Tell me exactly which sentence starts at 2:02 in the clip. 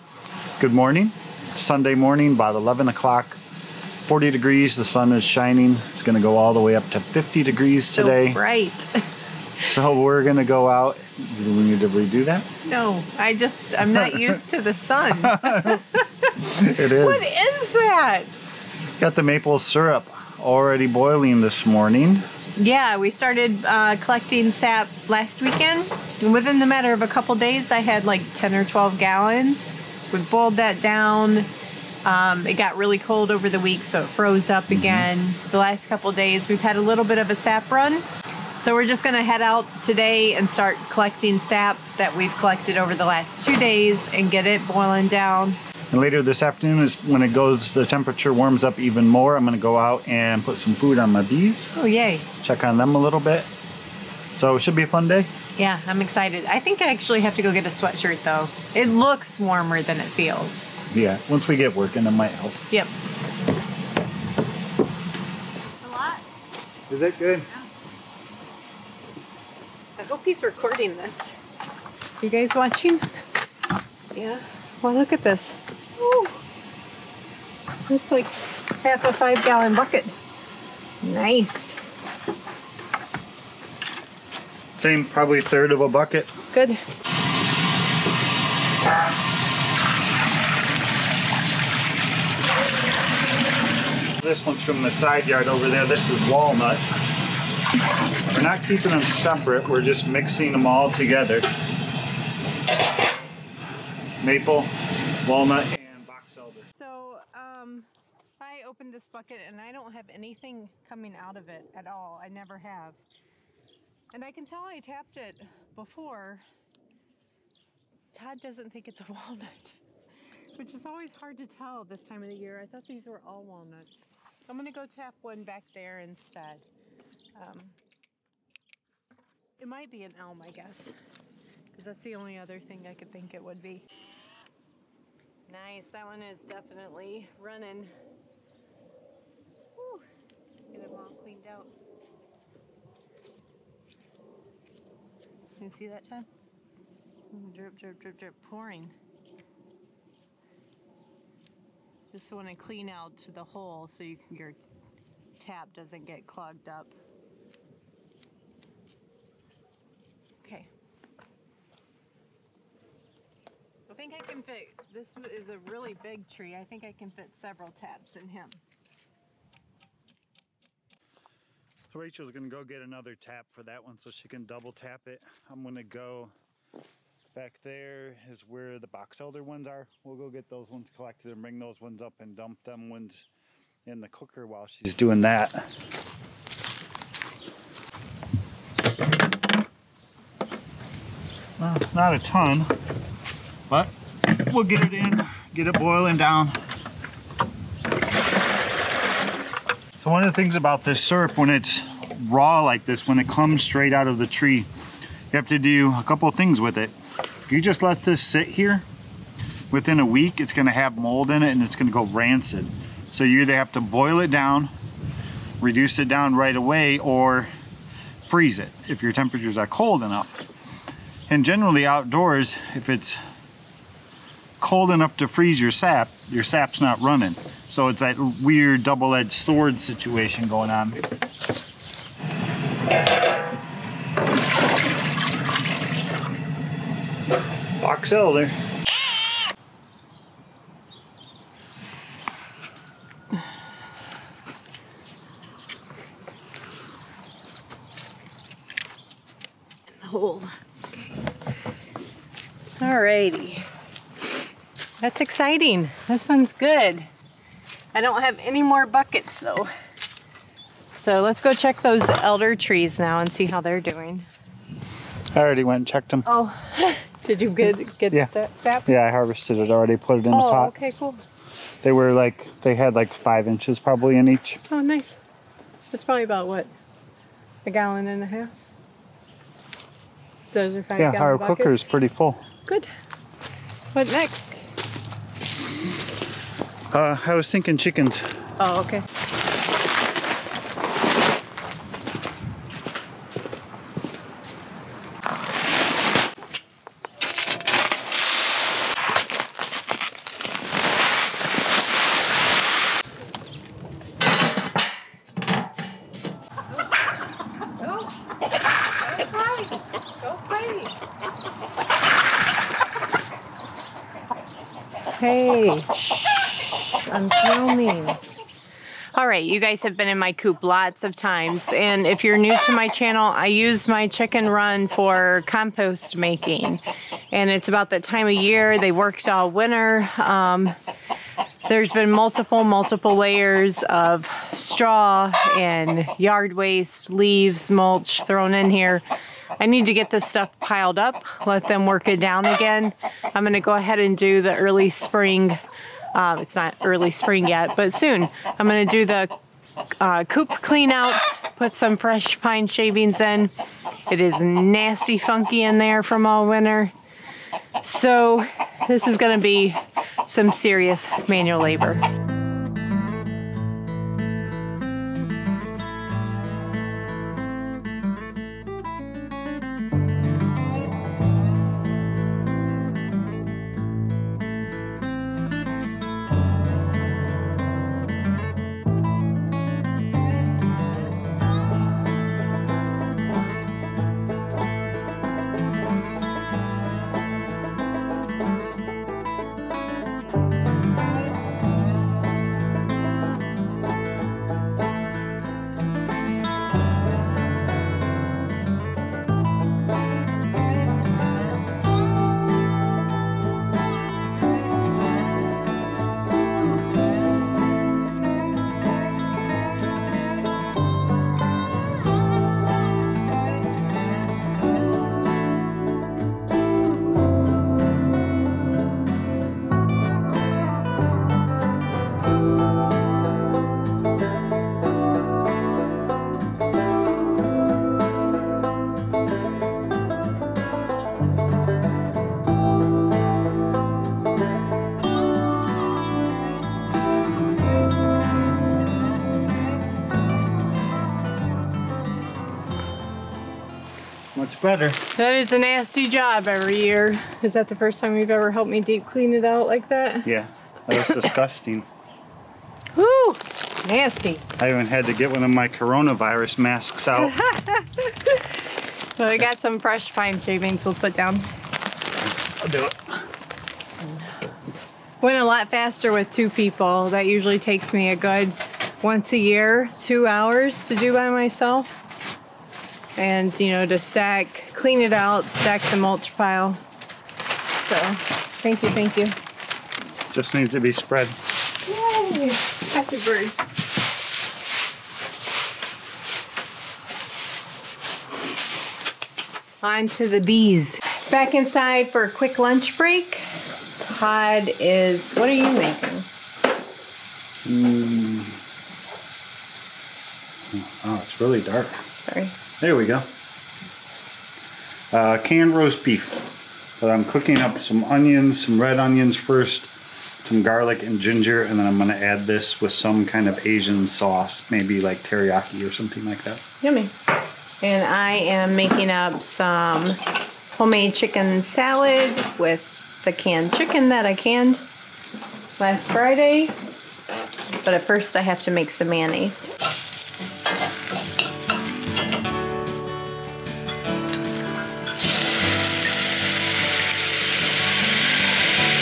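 I thought these were all walnuts.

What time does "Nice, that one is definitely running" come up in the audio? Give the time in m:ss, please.
2:15.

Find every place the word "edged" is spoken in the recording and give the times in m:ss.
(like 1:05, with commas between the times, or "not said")
3:48.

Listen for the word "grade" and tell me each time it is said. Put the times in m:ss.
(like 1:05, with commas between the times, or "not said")
not said.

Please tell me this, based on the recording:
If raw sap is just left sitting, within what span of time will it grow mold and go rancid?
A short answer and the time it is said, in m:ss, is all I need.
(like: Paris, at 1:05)
A week, at 3:29.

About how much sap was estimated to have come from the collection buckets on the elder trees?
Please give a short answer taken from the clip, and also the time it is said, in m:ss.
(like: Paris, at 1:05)
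A gallon and a half, at 4:37.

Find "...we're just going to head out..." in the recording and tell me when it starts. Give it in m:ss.
0:38.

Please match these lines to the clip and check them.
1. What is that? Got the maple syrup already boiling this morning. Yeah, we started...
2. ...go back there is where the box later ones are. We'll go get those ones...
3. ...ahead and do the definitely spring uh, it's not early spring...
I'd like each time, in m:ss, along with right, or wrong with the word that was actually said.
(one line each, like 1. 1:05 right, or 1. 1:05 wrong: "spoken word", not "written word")
1. 0:17 right
2. 2:55 wrong: "elder", not "later"
3. 5:43 wrong: "early", not "definitely".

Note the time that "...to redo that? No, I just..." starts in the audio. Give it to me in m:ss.
0:11.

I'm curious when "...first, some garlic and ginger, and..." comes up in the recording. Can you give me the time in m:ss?
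8:29.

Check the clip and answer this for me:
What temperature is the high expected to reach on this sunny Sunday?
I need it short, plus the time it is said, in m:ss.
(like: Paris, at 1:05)
50 degrees, at 0:06.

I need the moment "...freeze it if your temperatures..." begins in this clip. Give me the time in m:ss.
3:38.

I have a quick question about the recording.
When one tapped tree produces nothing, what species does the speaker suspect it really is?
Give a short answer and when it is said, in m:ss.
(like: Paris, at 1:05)
Elm, at 2:10.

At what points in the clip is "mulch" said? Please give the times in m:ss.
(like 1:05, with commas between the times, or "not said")
5:37, 7:55.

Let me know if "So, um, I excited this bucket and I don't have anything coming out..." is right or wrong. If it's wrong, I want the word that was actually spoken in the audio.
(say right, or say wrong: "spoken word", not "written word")
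wrong: "opened", not "excited".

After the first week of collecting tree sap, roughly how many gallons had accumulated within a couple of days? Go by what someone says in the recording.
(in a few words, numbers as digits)
10 or 12 gallons.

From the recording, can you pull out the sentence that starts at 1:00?
Yeah, once we get working, it might help.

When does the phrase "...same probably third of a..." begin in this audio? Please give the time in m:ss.
1:24.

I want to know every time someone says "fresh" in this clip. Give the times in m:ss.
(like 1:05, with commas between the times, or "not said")
5:51, 7:39.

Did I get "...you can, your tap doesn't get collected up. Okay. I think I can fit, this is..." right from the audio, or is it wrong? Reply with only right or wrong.
wrong.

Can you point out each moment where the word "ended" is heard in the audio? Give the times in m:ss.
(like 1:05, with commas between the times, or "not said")
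not said.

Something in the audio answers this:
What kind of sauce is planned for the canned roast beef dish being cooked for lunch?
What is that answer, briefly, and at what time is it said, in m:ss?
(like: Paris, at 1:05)
Teriyaki, at 8:35.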